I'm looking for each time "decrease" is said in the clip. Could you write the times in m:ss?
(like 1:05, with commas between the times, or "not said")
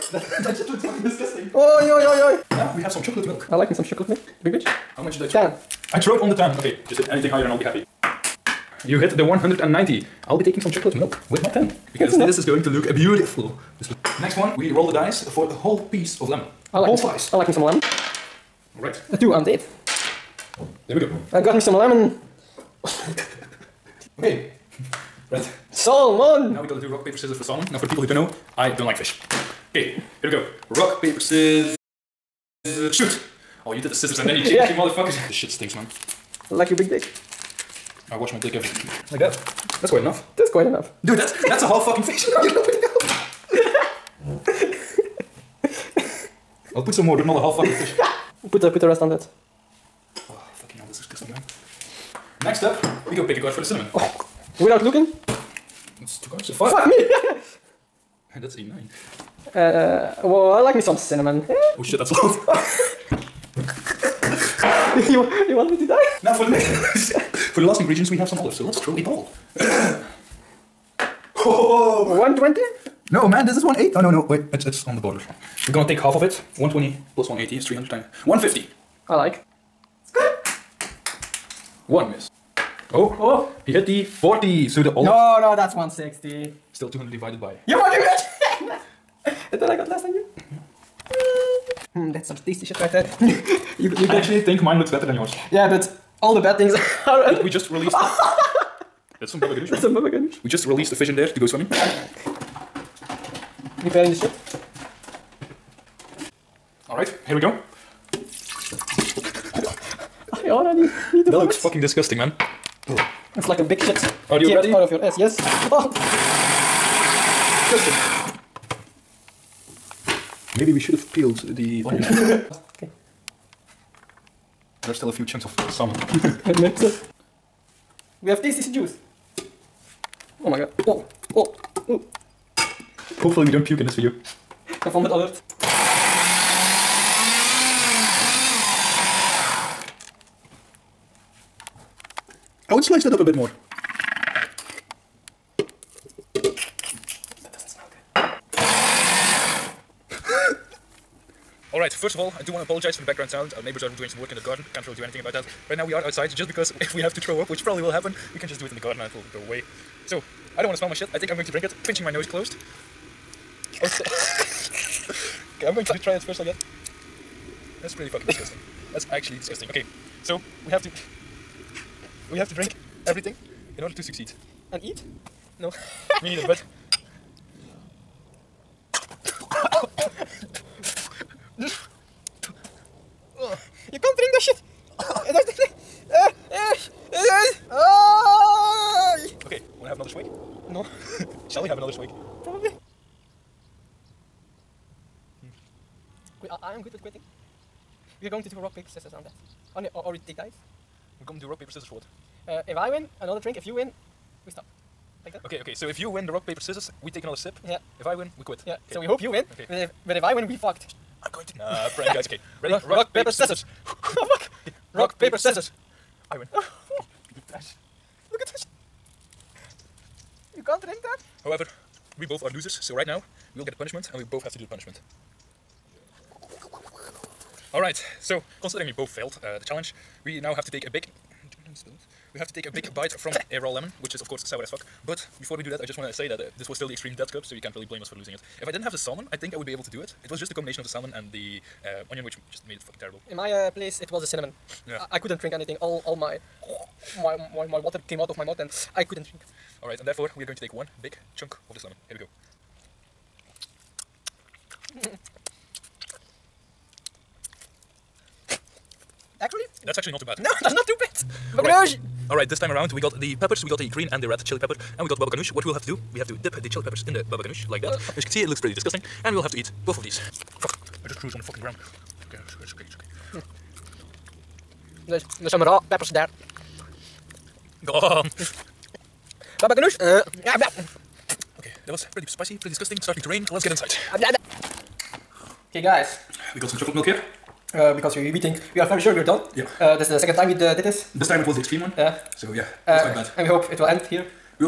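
not said.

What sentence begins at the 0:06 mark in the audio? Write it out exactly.
Okay, just hit anything higher and I'll be happy.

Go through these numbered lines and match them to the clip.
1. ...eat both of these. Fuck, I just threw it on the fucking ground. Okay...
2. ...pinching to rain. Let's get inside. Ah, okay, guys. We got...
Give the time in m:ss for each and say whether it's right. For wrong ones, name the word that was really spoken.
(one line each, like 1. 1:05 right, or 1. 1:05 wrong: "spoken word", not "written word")
1. 4:29 right
2. 4:43 wrong: "starting", not "pinching".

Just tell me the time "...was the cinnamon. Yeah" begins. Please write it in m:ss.
4:04.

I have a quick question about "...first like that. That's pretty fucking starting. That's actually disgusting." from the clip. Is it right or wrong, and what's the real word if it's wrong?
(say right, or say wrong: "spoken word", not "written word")
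wrong: "disgusting", not "starting".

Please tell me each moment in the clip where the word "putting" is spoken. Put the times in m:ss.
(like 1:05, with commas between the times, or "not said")
0:42.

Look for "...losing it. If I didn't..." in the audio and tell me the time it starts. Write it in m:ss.
3:58.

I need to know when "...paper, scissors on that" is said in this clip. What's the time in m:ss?
3:18.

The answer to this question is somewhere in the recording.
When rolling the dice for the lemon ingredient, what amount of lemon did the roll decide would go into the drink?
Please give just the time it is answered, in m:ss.
0:16.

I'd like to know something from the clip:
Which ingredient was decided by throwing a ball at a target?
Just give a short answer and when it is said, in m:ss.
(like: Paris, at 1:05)
olives, at 1:08.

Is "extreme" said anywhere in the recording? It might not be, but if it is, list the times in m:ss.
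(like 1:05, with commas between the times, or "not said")
3:56, 4:51.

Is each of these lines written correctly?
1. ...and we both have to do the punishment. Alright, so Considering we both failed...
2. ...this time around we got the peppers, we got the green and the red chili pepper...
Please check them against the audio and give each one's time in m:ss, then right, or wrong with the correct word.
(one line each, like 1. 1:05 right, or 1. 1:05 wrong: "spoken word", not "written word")
1. 3:44 right
2. 4:22 right.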